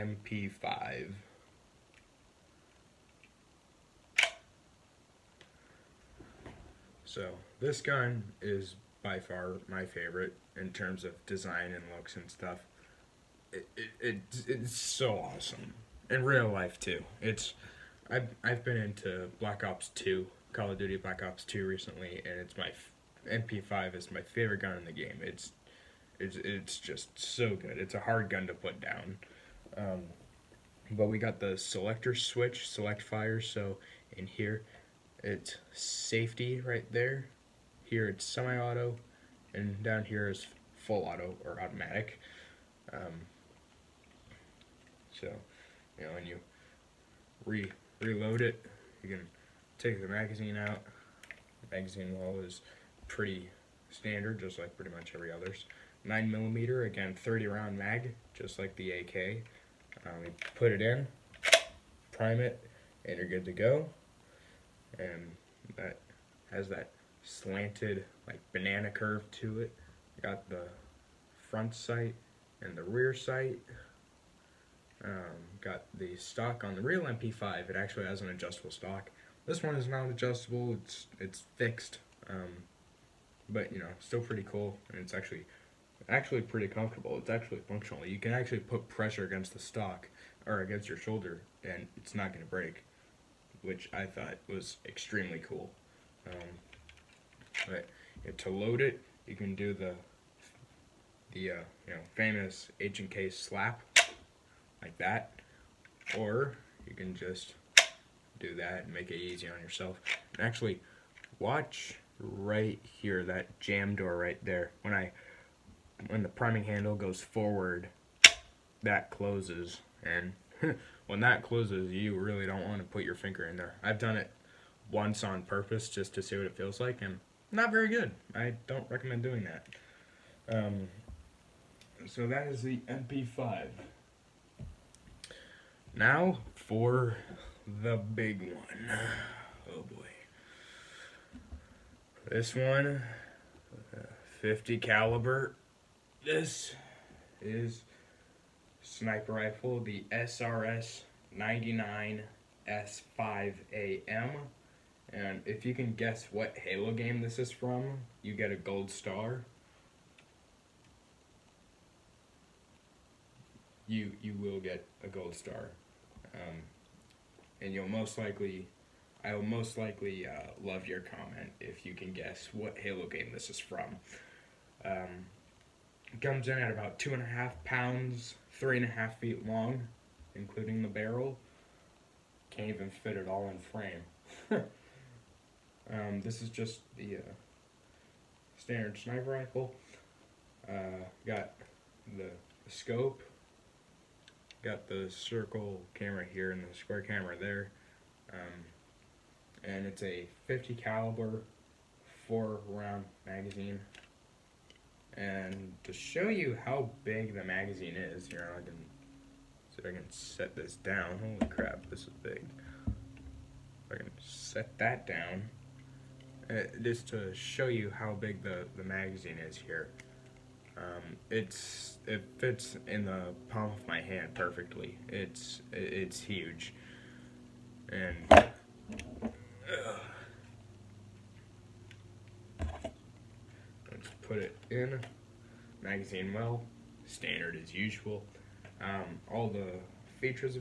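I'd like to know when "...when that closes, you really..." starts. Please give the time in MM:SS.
02:01.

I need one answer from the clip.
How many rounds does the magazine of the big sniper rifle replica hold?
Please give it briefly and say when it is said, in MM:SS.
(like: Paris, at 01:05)
4, at 03:22.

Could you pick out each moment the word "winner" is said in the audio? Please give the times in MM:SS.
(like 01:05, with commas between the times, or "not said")
not said.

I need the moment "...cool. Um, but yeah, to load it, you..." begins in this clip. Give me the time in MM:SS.
01:35.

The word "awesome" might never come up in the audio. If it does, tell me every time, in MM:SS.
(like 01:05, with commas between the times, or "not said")
00:15.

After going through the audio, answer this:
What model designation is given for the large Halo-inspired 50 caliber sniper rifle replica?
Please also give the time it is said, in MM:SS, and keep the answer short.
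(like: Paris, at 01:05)
SRS 99 S5AM, at 02:30.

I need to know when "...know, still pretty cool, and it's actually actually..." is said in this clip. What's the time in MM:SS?
01:23.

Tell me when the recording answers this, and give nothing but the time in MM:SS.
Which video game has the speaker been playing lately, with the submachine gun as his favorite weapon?
00:20.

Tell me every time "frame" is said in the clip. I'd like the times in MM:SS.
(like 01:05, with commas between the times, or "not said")
03:03.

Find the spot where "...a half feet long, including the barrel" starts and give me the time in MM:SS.
02:58.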